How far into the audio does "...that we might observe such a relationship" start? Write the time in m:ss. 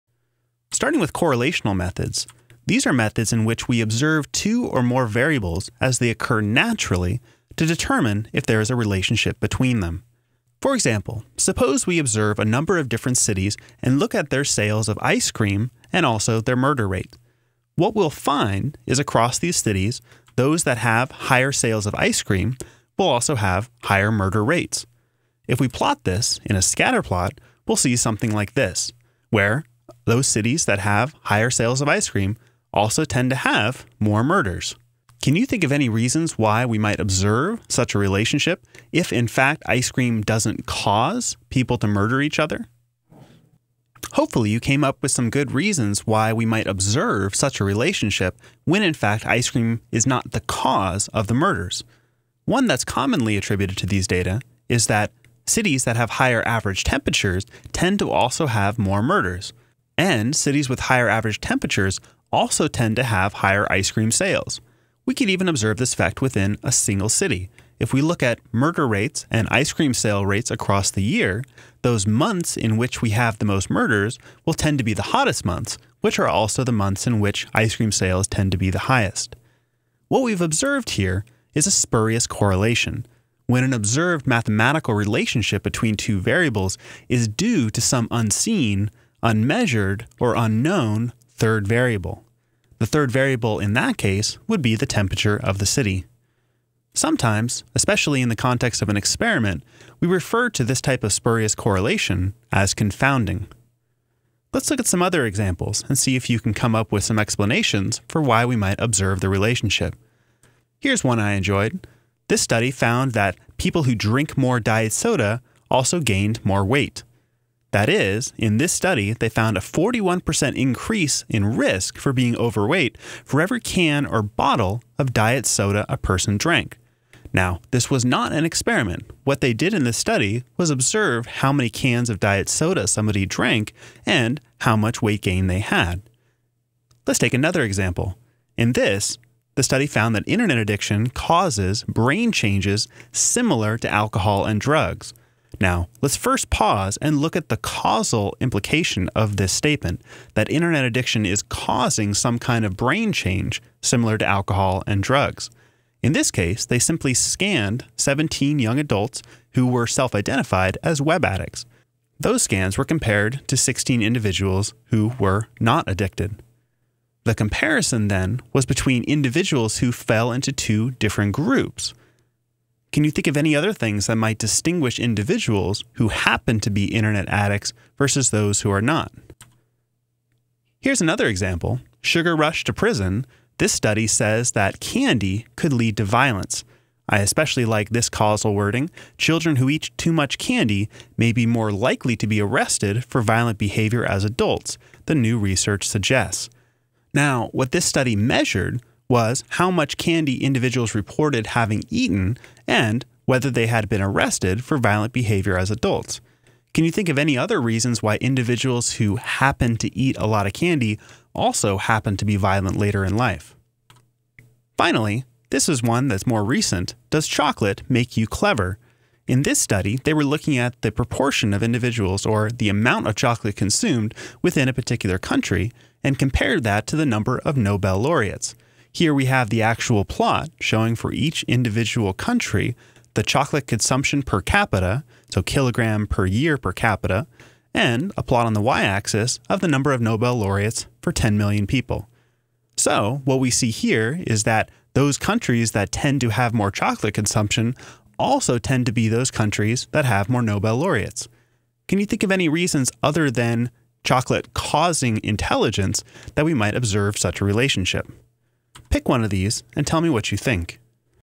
4:16.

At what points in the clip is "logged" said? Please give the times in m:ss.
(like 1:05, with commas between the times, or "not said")
not said.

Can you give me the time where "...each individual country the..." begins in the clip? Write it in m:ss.
3:51.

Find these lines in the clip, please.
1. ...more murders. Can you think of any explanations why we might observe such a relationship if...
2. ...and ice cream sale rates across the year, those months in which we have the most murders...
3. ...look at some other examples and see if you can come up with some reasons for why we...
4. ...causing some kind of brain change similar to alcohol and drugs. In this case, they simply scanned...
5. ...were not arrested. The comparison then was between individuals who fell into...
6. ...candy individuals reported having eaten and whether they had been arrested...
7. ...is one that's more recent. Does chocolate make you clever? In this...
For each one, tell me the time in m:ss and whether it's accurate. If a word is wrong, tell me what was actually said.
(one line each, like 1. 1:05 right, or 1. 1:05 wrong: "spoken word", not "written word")
1. 0:33 wrong: "reasons", not "explanations"
2. 1:09 right
3. 1:44 wrong: "explanations", not "reasons"
4. 2:31 right
5. 2:45 wrong: "addicted", not "arrested"
6. 3:19 right
7. 3:35 right.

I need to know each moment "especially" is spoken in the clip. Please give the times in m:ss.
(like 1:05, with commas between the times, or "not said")
1:37, 3:07.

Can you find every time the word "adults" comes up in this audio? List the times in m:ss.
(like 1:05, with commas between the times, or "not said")
2:38, 3:14, 3:25.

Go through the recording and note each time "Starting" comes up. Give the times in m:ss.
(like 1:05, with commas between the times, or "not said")
0:00.